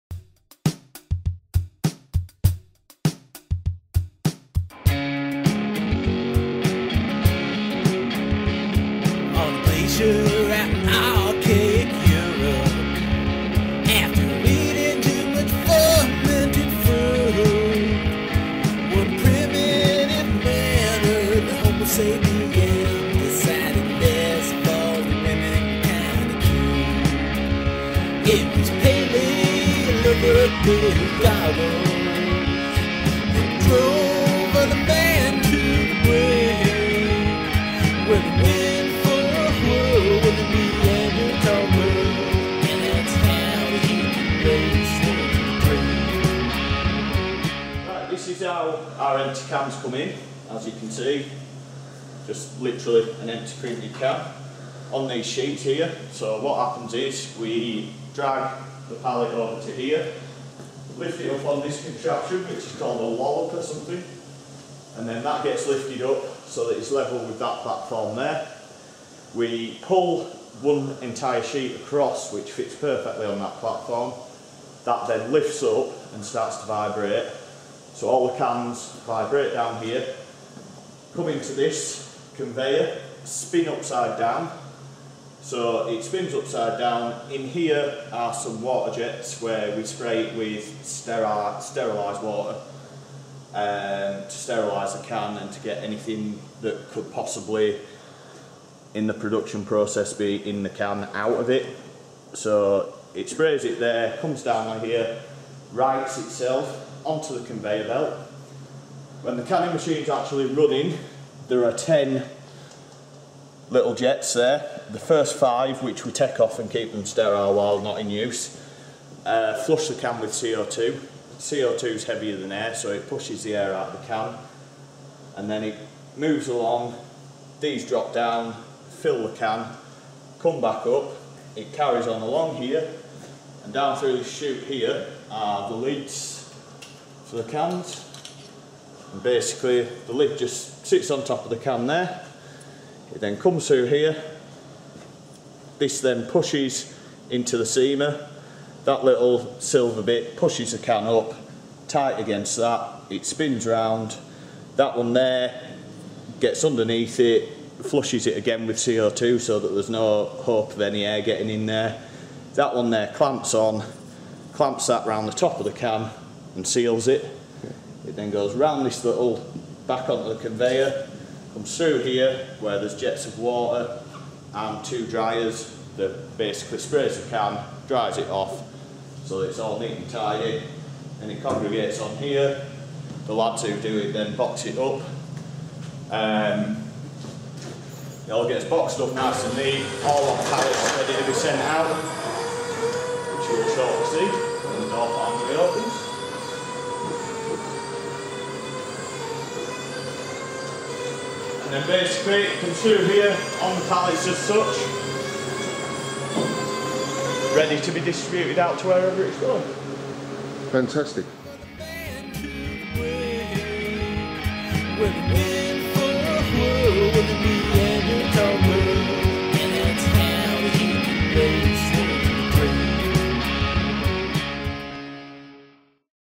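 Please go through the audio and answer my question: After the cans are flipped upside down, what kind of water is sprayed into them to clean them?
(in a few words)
Sterilised water.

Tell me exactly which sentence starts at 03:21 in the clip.
And then basically you can see here on the pallets as such, ready to be distributed out to wherever it's going.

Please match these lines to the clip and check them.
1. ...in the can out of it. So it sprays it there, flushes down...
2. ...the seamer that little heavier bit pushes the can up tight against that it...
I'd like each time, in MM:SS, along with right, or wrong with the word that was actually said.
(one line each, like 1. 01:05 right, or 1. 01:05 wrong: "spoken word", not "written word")
1. 01:40 wrong: "comes", not "flushes"
2. 02:27 wrong: "silver", not "heavier".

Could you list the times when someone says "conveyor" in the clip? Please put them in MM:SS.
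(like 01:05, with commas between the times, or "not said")
01:22, 01:47, 02:50.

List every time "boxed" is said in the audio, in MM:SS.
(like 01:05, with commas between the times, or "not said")
03:08.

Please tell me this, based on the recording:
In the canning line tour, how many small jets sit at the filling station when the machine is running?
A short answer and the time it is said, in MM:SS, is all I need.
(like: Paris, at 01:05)
10, at 01:51.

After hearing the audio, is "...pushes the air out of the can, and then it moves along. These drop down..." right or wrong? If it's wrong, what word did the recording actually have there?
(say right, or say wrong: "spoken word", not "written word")
right.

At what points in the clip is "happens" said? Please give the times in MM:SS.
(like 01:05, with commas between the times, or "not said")
00:56.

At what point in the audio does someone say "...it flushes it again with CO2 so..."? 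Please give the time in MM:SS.
02:37.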